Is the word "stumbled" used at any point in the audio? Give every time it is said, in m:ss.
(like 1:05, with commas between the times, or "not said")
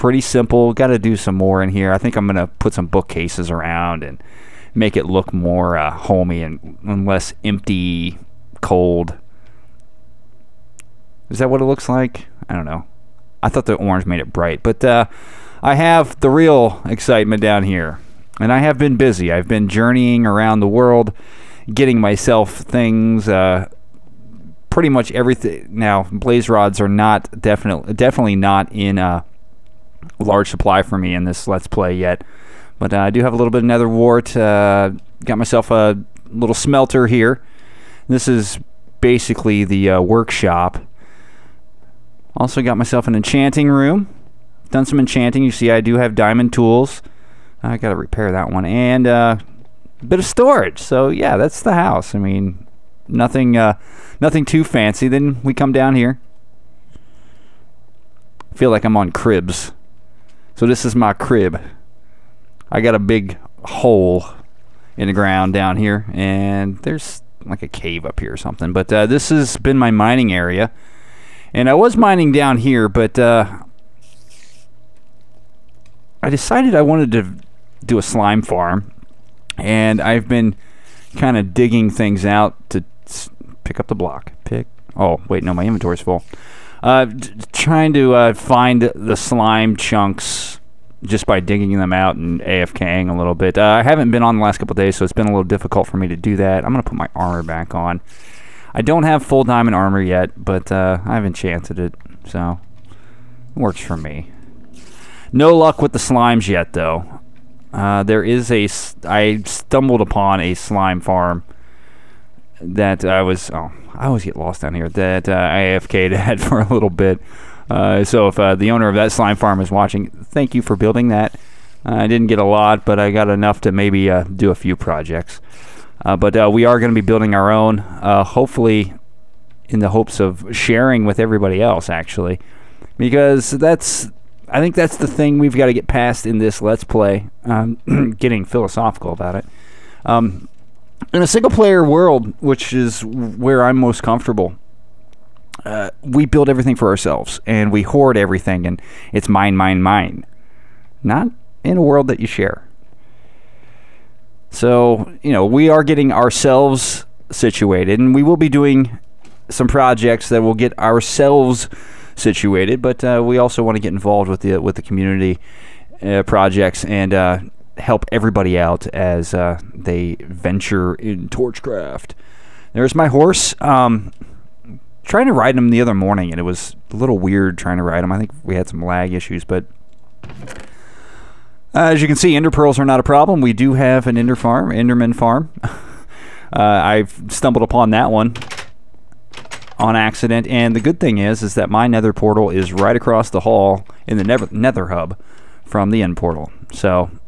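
1:49, 3:07.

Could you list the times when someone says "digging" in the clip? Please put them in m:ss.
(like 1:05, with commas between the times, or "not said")
1:21, 1:31.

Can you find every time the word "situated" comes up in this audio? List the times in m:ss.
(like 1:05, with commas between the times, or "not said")
2:37, 2:42.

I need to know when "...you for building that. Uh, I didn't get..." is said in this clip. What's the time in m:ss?
2:00.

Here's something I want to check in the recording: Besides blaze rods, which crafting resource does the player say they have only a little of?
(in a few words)
nether wart.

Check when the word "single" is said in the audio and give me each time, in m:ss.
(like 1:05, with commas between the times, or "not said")
2:21.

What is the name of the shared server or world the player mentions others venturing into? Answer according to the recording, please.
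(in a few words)
torchcraft.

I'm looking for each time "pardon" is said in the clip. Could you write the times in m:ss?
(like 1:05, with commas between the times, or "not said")
not said.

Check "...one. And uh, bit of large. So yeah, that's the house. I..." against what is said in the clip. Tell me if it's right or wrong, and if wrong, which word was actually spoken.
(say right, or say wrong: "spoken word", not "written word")
wrong: "storage", not "large".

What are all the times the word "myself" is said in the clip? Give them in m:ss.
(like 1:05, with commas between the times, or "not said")
0:22, 0:35, 0:42.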